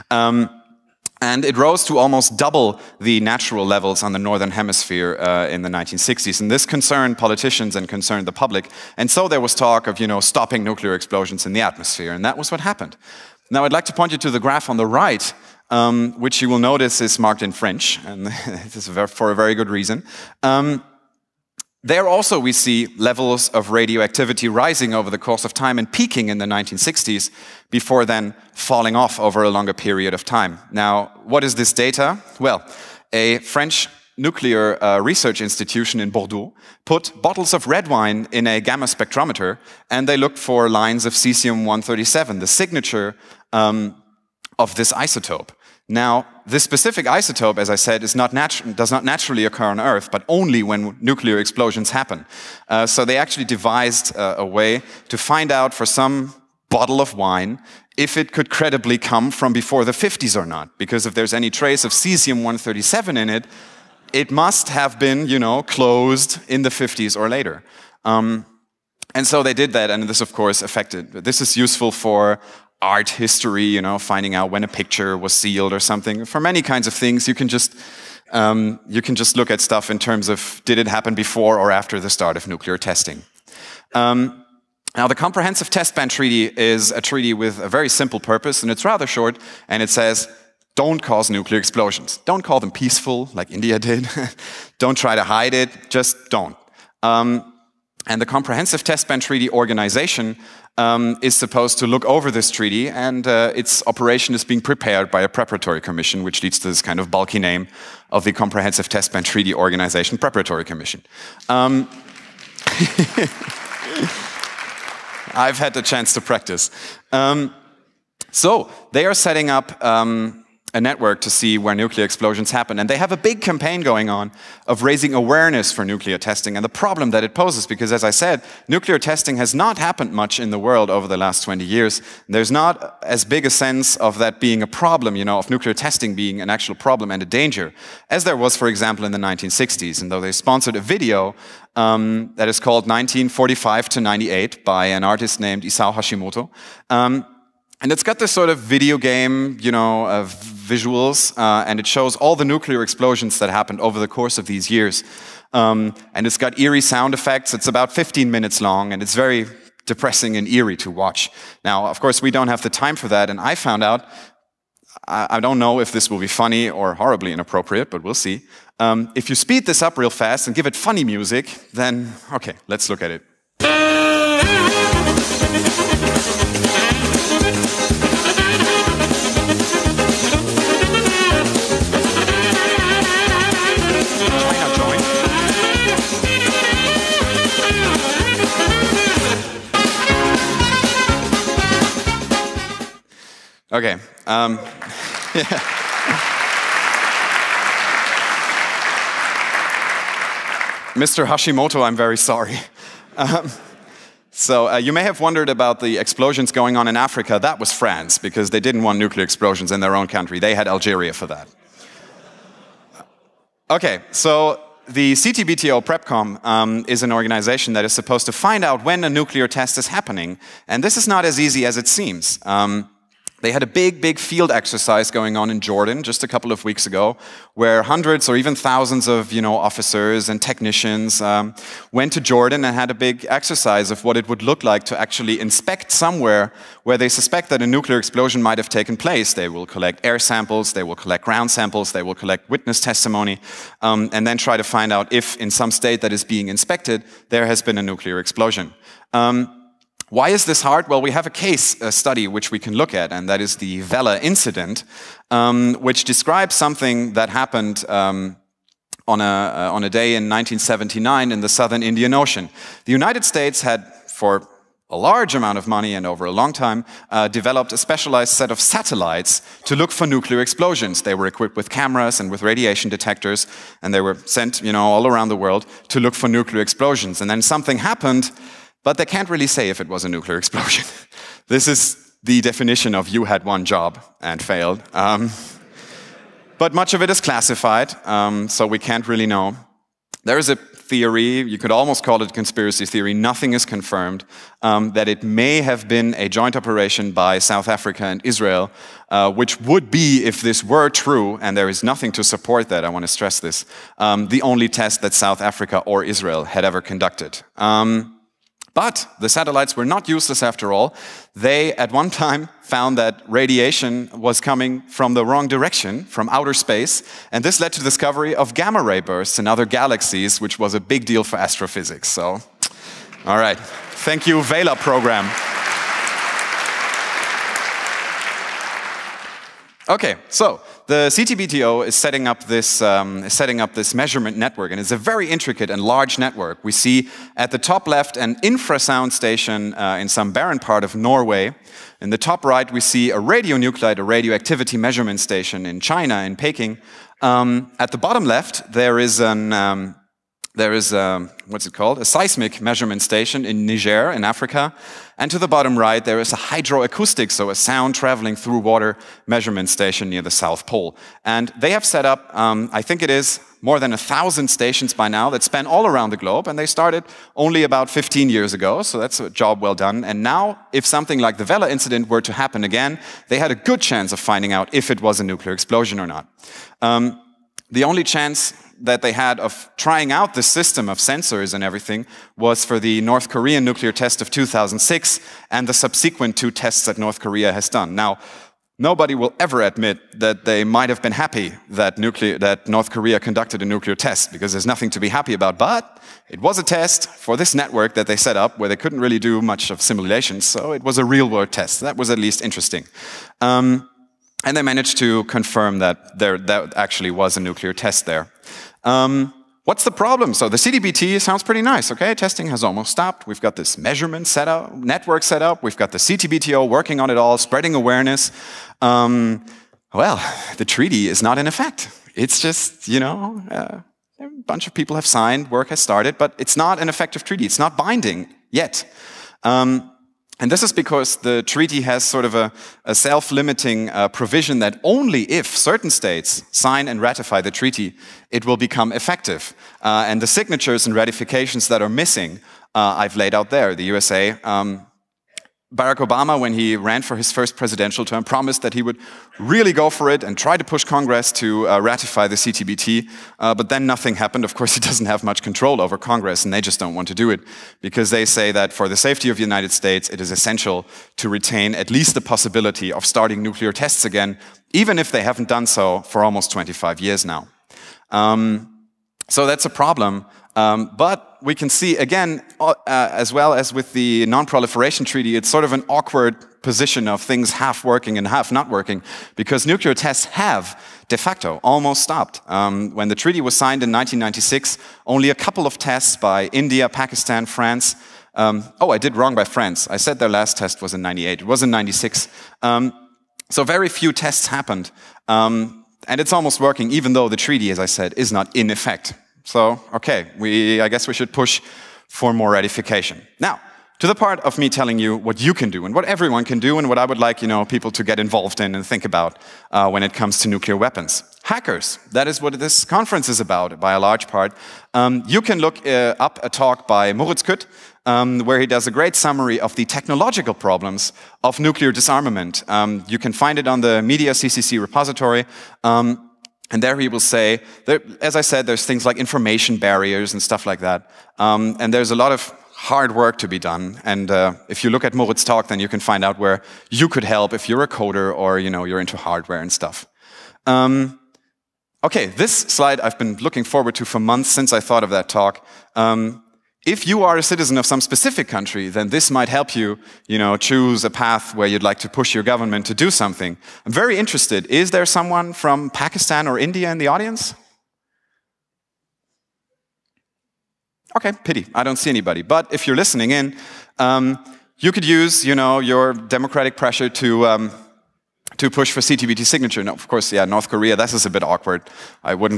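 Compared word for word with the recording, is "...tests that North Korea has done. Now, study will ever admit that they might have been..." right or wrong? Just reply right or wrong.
wrong.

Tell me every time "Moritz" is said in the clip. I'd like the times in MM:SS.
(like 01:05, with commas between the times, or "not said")
08:37, 08:55.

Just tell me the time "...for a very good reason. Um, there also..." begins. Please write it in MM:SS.
00:19.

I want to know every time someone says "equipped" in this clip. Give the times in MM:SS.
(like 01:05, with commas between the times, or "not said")
04:31.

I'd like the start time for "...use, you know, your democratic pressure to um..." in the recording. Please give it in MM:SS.
09:25.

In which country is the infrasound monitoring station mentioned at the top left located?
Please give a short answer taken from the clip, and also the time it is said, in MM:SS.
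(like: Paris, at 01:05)
Norway, at 05:40.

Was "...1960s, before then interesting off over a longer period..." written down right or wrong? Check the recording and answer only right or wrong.
wrong.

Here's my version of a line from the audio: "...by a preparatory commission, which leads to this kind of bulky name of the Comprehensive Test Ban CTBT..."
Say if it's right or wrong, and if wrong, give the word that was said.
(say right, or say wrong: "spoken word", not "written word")
wrong: "Treaty", not "CTBT".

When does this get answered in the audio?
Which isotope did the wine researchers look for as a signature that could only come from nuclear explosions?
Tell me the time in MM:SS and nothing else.
00:41.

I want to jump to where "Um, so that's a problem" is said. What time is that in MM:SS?
07:48.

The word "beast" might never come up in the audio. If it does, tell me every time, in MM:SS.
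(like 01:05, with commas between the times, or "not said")
not said.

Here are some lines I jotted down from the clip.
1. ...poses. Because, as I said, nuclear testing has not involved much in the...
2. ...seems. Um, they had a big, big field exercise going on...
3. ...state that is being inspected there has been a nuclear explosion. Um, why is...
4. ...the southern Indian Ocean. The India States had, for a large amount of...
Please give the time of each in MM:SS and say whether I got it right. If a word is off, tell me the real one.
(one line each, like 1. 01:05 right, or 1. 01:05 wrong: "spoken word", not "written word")
1. 02:07 wrong: "happened", not "involved"
2. 03:41 right
3. 04:05 right
4. 04:21 wrong: "United", not "India".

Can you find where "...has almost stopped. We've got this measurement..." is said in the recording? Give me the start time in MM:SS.
06:52.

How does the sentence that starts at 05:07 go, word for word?
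Um, but the satellites were not useless after all.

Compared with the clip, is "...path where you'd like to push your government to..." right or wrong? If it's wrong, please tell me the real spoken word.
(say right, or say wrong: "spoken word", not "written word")
right.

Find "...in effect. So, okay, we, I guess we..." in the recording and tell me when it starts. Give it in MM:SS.
08:18.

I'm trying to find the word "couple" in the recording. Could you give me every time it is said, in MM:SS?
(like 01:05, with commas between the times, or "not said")
03:46, 08:05.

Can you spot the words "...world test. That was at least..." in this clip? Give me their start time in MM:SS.
06:41.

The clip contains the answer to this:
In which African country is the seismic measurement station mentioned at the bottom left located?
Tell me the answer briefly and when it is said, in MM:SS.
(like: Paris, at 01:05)
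Niger, at 05:53.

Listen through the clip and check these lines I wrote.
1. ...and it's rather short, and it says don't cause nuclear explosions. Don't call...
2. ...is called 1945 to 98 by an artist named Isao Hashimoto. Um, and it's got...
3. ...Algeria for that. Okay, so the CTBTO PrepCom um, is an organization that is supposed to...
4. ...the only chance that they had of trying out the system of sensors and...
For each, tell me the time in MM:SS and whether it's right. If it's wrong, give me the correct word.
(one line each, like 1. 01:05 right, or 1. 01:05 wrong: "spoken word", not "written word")
1. 01:28 right
2. 02:22 right
3. 03:30 right
4. 06:17 right.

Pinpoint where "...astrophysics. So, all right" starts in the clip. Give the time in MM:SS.
05:21.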